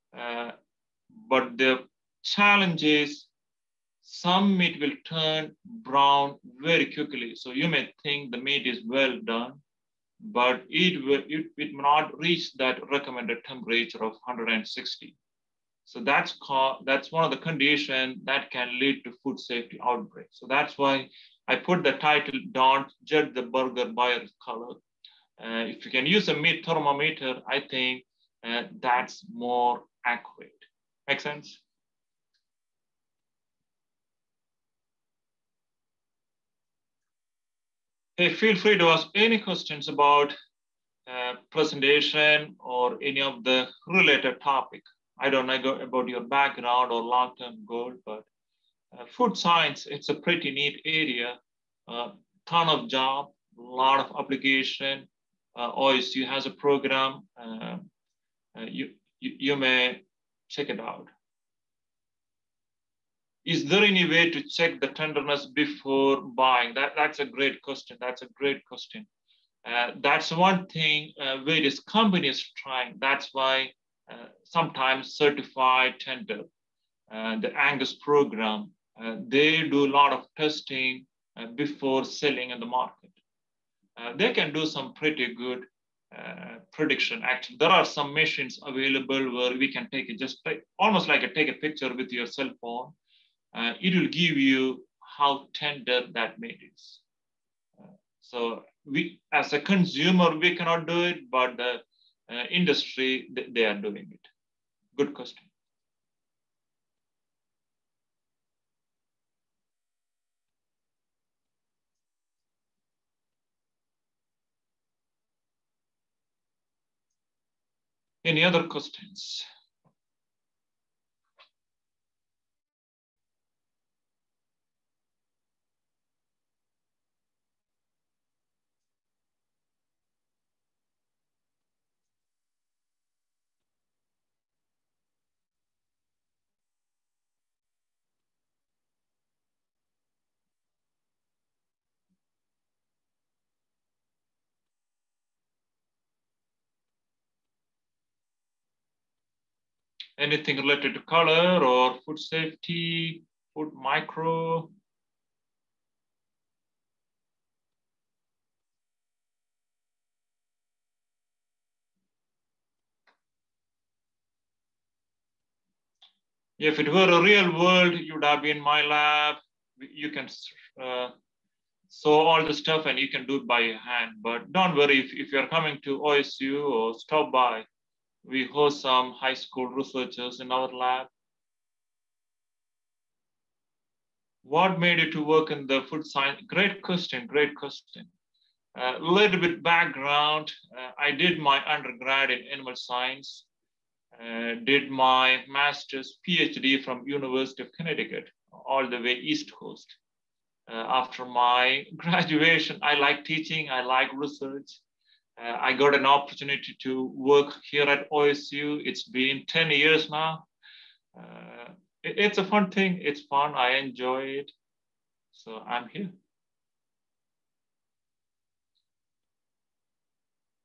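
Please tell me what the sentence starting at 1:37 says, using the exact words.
Uh, so we, as a consumer, we cannot do it, but the uh, industry, th they are doing it.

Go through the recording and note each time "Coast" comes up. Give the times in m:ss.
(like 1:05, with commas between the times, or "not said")
3:19.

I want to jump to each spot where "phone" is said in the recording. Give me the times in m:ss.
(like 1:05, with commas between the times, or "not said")
1:32.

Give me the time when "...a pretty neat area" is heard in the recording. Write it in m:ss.
0:50.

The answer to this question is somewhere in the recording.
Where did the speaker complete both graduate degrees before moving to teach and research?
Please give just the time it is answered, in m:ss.
3:17.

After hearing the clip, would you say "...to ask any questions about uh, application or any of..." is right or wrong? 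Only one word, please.
wrong.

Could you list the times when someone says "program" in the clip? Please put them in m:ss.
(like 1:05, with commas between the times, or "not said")
0:56, 1:17.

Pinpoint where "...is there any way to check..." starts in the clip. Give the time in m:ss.
1:03.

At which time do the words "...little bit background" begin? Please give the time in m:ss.
3:08.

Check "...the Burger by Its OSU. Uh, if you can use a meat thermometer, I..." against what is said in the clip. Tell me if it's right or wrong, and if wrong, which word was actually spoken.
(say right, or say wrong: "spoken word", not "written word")
wrong: "Color", not "OSU".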